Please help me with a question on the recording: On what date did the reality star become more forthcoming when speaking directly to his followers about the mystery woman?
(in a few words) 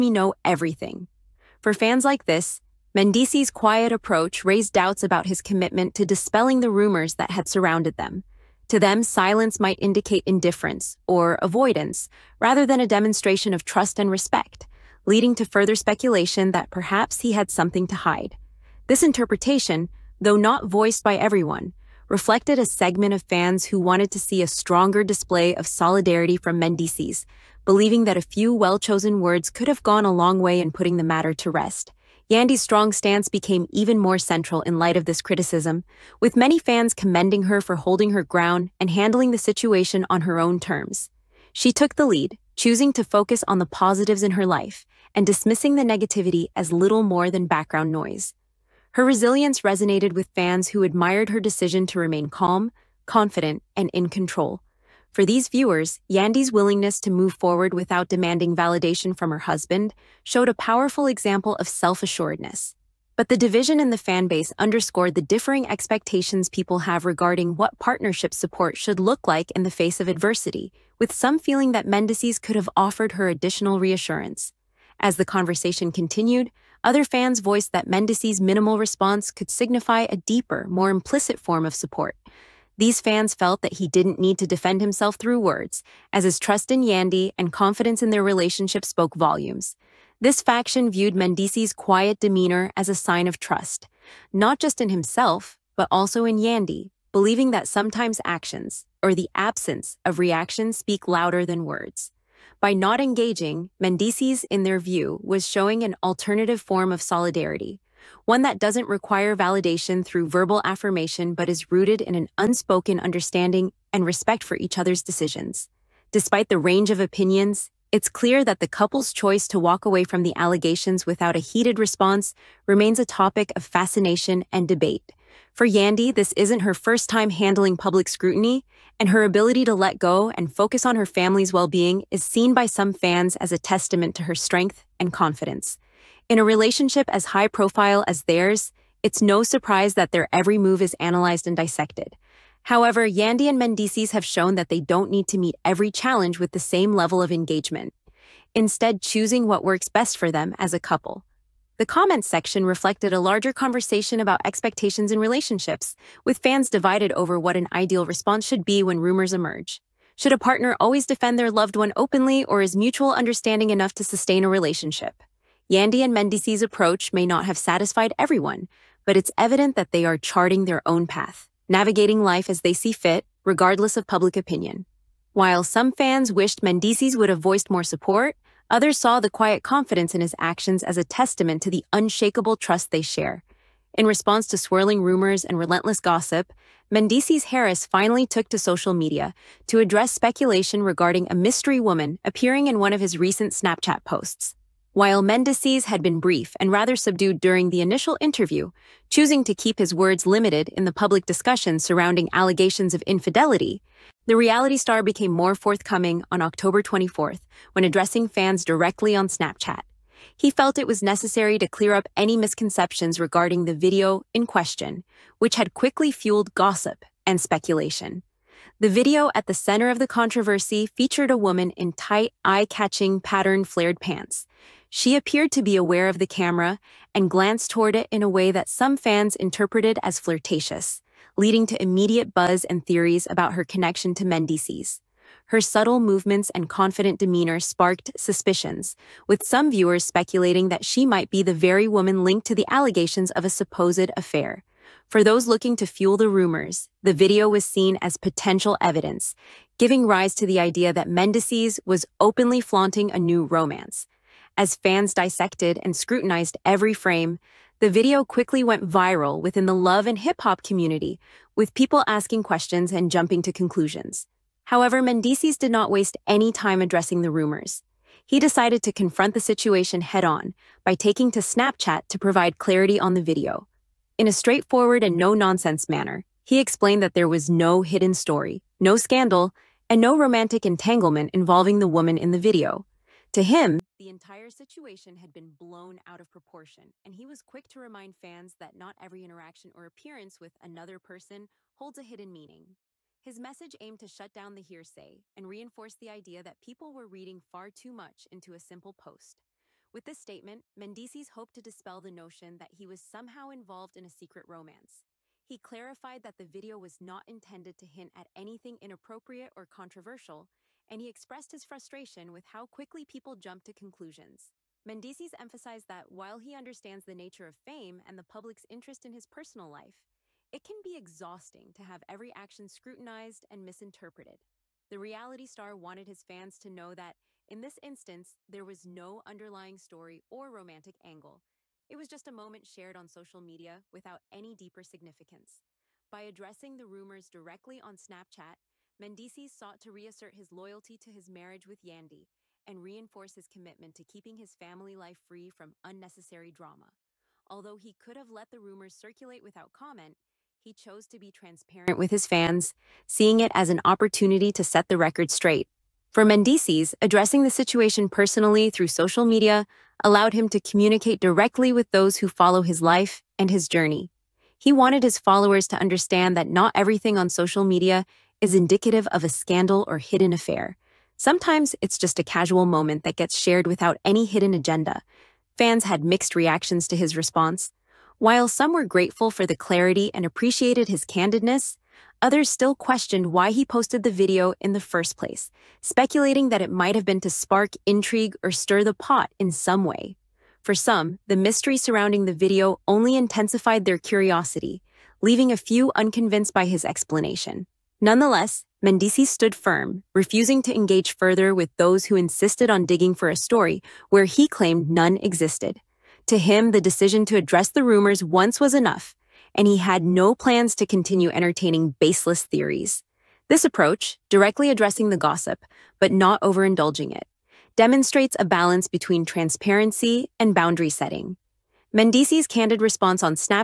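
October 24th.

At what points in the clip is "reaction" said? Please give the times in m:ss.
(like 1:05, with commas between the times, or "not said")
1:40, 6:16.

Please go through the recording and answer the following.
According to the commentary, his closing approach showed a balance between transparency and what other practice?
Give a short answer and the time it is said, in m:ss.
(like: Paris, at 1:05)
Boundary setting, at 7:00.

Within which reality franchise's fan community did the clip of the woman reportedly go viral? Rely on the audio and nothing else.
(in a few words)
Love and Hip Hop.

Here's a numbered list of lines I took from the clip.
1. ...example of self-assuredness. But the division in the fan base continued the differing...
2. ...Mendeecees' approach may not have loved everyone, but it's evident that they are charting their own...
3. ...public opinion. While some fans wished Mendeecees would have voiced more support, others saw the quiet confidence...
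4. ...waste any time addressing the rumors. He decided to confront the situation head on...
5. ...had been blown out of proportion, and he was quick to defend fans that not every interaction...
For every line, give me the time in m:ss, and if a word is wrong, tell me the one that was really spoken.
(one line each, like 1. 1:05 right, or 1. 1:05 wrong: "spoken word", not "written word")
1. 1:01 wrong: "underscored", not "continued"
2. 2:46 wrong: "satisfied", not "loved"
3. 2:54 right
4. 4:25 right
5. 4:45 wrong: "remind", not "defend".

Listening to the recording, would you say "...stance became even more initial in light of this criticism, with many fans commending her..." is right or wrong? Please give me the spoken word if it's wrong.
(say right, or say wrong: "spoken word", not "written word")
wrong: "central", not "initial".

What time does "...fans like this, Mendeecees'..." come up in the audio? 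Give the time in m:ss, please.
0:01.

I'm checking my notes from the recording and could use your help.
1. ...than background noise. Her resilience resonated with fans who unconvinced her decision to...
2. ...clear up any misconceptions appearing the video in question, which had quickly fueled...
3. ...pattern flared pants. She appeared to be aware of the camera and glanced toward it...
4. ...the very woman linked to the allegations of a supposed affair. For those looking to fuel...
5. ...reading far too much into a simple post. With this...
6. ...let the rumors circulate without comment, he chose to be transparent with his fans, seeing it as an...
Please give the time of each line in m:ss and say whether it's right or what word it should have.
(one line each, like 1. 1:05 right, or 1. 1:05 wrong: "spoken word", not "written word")
1. 0:47 wrong: "admired", not "unconvinced"
2. 3:31 wrong: "regarding", not "appearing"
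3. 3:43 right
4. 4:01 right
5. 4:57 right
6. 5:48 right.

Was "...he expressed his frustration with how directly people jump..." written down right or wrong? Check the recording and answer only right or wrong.
wrong.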